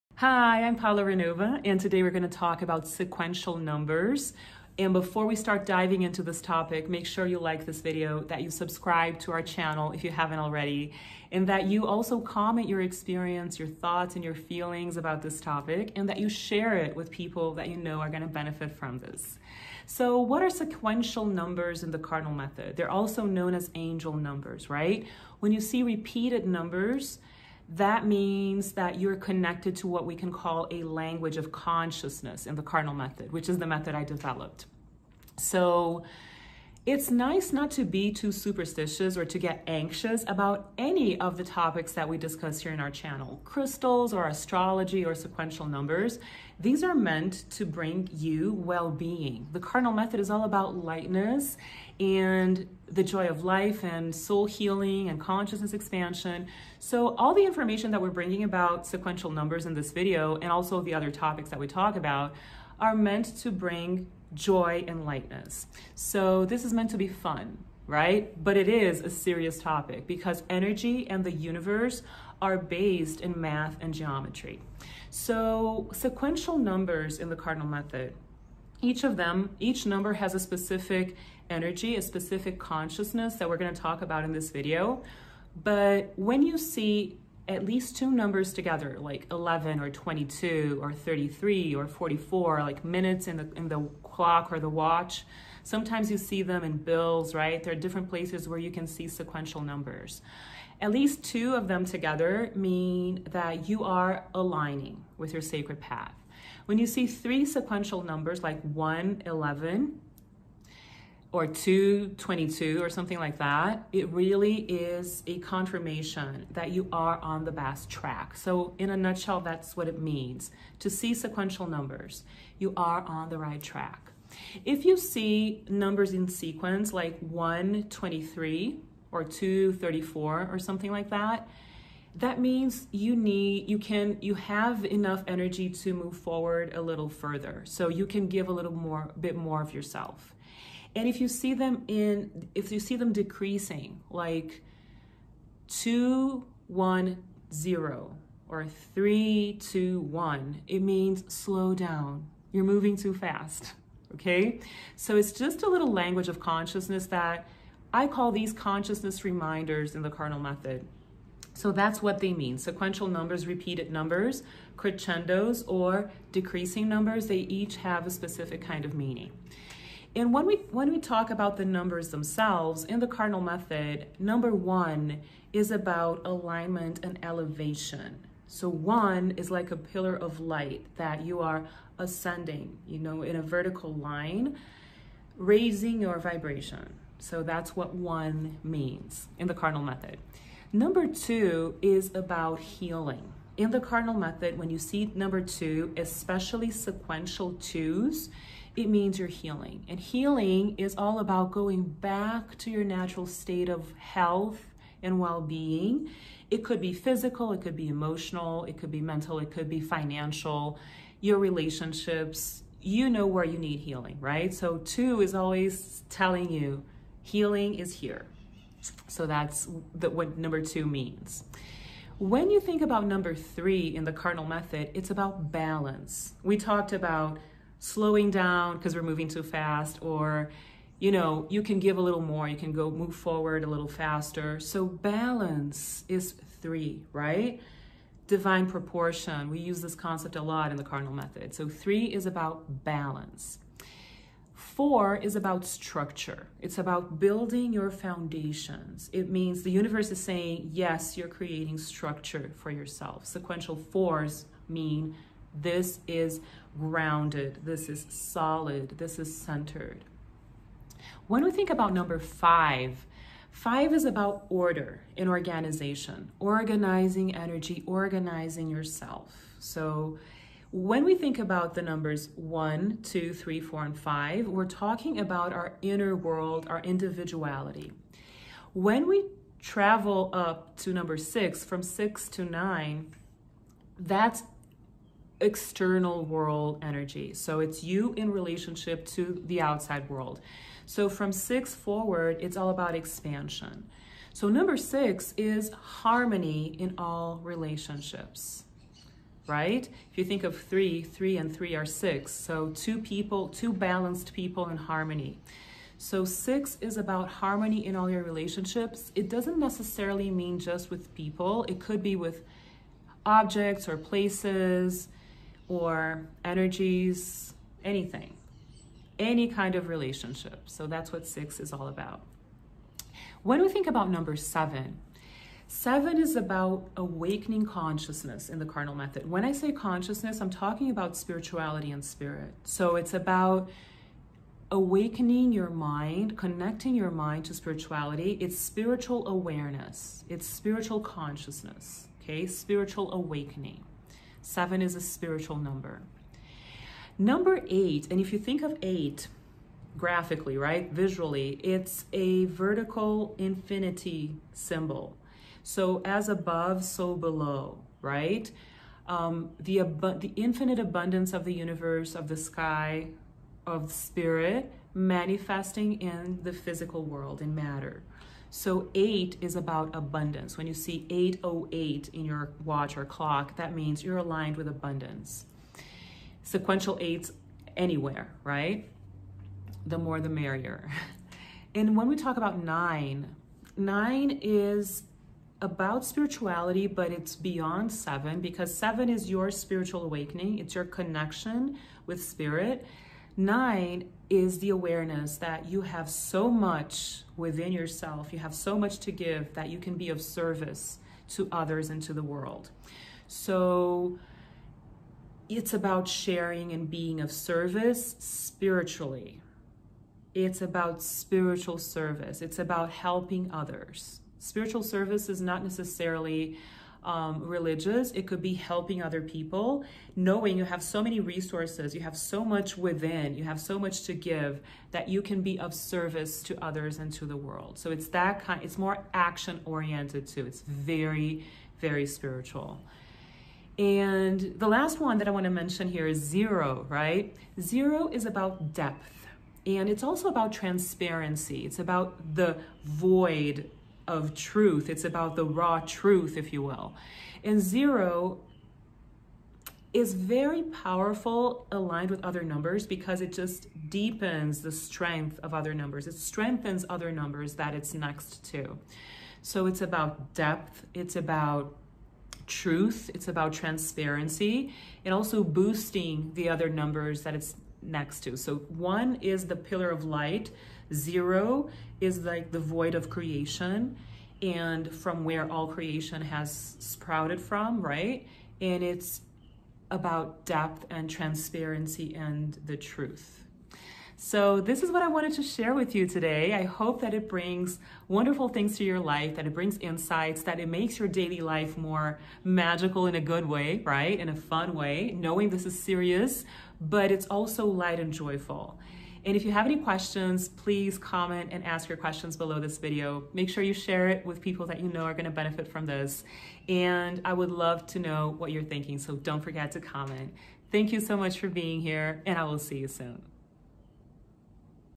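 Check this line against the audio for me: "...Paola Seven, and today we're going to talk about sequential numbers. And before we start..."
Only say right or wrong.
wrong.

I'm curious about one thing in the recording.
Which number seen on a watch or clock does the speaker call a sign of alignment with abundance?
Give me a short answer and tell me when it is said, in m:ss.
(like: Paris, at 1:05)
808, at 6:11.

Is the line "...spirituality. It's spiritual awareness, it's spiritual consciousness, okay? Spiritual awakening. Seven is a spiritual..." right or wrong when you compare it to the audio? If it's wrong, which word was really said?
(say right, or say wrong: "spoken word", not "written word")
right.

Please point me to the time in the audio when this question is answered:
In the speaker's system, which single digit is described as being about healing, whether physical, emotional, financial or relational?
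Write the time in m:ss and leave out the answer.
3:10.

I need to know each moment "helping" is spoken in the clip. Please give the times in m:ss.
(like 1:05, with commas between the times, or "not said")
6:52, 6:58.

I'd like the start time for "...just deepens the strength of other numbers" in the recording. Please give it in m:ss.
7:33.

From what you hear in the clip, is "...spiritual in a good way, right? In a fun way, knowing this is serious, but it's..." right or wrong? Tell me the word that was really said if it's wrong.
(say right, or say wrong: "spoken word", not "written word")
wrong: "magical", not "spiritual".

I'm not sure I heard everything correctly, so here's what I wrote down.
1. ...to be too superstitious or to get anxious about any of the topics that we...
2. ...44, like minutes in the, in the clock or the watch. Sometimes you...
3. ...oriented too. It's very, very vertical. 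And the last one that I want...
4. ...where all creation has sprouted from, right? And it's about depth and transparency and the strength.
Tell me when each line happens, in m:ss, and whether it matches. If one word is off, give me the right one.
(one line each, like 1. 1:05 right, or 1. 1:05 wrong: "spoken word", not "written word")
1. 0:37 right
2. 1:31 right
3. 7:09 wrong: "spiritual", not "vertical"
4. 7:55 wrong: "truth", not "strength".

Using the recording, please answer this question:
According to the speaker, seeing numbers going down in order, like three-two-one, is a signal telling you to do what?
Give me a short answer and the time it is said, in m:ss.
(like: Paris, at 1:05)
Slow down, at 2:31.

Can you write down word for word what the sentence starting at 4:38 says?
When we travel up to number six, from six to nine, that's external world energy.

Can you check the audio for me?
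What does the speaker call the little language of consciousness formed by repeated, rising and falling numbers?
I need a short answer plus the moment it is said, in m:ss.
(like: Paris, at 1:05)
Consciousness reminders, at 2:38.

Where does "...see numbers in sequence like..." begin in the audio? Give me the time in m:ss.
2:04.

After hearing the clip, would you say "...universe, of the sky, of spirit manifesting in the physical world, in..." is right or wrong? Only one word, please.
right.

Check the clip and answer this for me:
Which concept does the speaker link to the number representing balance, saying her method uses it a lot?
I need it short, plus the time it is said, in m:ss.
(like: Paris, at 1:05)
Divine proportion, at 3:58.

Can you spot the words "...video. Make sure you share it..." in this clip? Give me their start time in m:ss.
8:22.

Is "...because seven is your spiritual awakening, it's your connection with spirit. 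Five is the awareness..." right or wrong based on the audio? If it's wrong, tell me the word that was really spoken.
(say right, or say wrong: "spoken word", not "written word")
wrong: "Nine", not "Five".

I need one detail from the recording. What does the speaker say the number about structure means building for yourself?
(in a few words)
Foundations.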